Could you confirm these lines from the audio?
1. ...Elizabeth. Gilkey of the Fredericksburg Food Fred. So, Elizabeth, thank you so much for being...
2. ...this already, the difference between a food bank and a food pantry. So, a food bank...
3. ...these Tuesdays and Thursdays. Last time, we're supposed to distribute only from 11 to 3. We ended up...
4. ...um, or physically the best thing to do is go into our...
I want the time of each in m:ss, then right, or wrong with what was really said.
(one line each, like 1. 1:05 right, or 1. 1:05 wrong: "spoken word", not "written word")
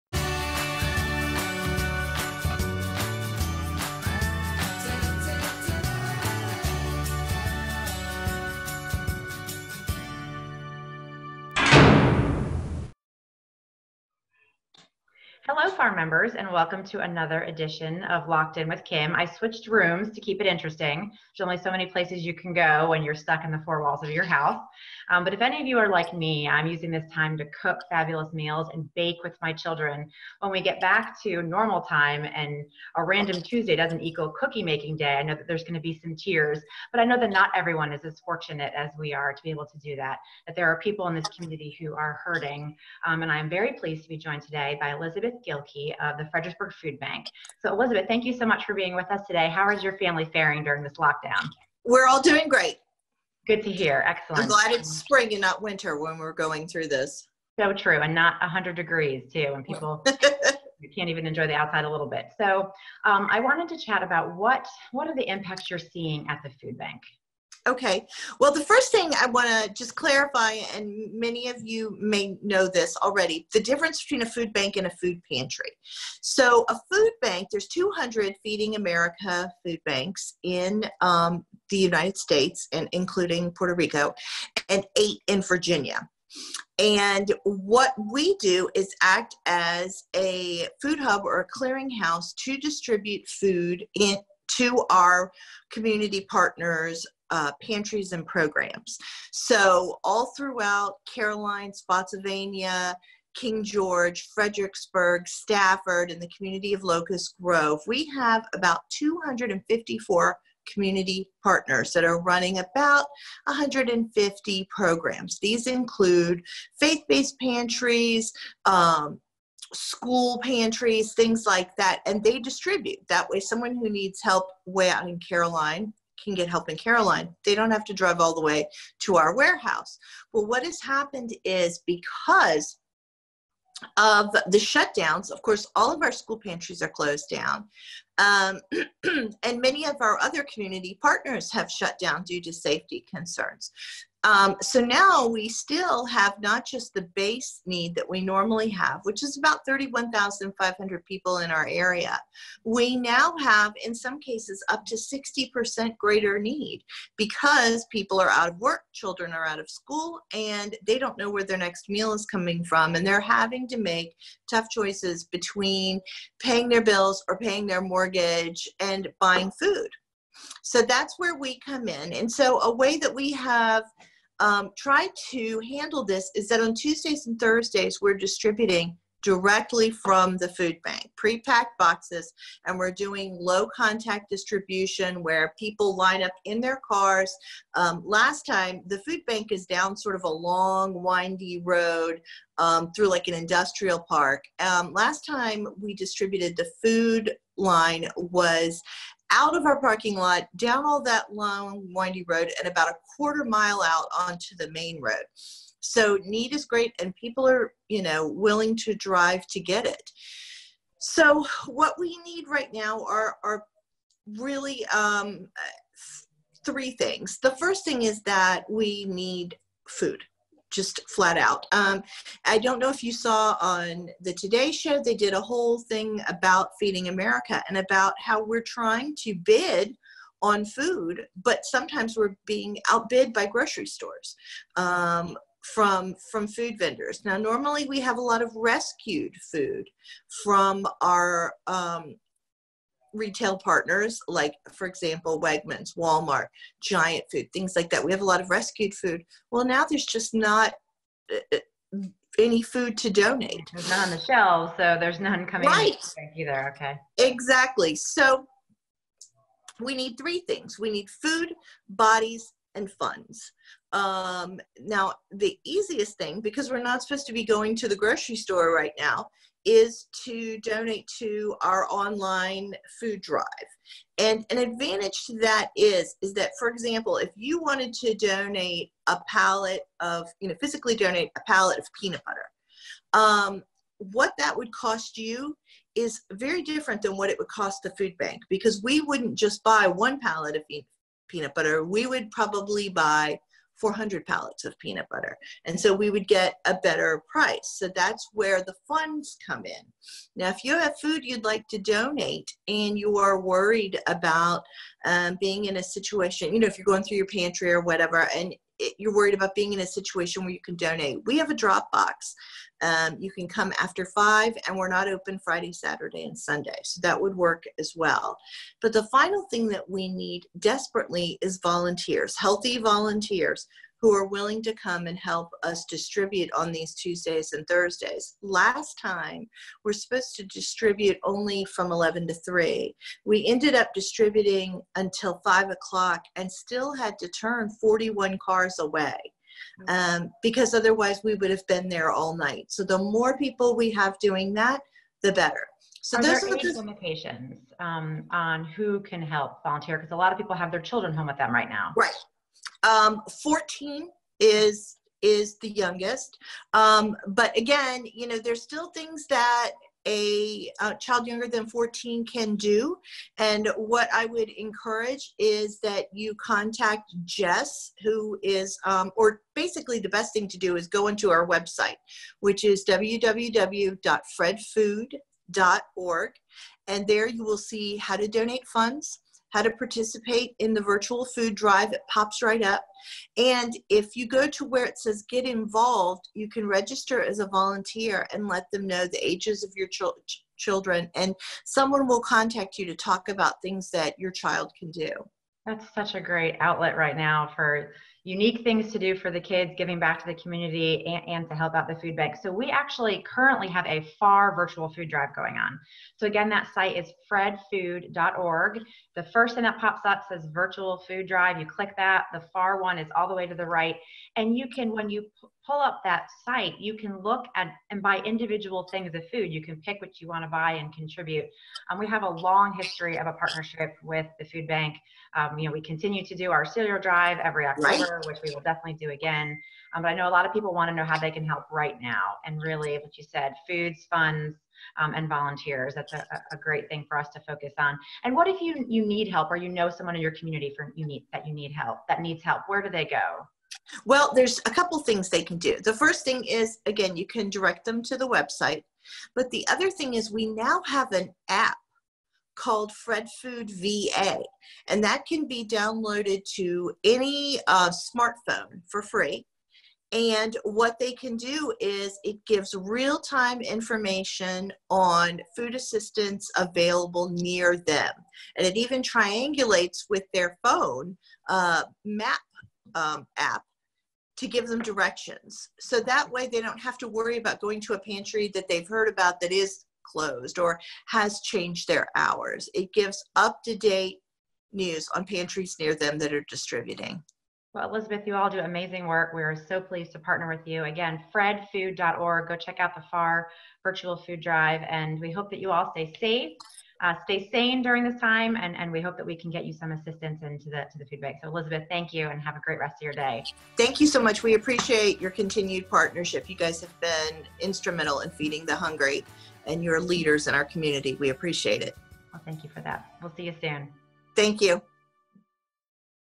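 1. 0:44 wrong: "Bank", not "Fred"
2. 1:12 right
3. 5:26 right
4. 6:08 wrong: "basically", not "physically".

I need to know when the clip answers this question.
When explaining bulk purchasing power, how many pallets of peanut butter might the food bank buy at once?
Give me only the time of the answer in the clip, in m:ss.
4:53.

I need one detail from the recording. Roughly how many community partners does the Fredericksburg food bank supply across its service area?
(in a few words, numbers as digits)
254.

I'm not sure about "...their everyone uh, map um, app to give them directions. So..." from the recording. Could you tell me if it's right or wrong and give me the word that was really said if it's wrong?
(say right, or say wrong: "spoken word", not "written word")
wrong: "phone", not "everyone".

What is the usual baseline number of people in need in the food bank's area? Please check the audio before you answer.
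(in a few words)
31,500.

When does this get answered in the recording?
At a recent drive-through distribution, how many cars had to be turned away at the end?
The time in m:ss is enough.
5:37.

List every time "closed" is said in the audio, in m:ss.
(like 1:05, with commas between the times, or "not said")
2:16, 8:00.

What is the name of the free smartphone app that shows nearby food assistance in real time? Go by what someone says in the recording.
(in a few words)
Fred Food VA.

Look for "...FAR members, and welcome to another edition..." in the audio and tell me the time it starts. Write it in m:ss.
0:15.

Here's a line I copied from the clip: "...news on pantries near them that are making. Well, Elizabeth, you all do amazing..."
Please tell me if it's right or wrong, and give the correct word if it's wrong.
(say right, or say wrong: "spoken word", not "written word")
wrong: "distributing", not "making".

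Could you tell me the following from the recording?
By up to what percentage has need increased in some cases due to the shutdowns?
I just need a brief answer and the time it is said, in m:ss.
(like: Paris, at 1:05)
60%, at 2:34.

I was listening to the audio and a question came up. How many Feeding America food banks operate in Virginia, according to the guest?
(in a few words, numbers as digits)
8.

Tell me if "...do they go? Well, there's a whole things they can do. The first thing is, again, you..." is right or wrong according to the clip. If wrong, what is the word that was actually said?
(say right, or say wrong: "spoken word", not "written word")
wrong: "couple", not "whole".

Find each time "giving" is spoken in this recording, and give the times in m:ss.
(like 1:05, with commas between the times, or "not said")
6:39.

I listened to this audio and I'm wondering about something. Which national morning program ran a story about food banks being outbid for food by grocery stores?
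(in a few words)
The Today Show.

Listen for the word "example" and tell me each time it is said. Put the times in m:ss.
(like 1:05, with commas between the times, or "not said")
4:04, 4:36.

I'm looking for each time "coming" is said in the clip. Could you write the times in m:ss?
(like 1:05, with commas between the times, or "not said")
2:42, 4:15.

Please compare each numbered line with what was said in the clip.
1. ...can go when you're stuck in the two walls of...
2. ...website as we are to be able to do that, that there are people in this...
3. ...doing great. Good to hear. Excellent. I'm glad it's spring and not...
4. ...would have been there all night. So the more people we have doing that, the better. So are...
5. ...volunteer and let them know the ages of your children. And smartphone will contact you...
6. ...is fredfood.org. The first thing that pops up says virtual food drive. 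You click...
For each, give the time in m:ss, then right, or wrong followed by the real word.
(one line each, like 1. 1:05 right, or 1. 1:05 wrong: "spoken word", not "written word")
1. 0:22 wrong: "four", not "two"
2. 0:38 wrong: "fortunate", not "website"
3. 0:52 right
4. 5:41 right
5. 6:27 wrong: "someone", not "smartphone"
6. 6:46 right.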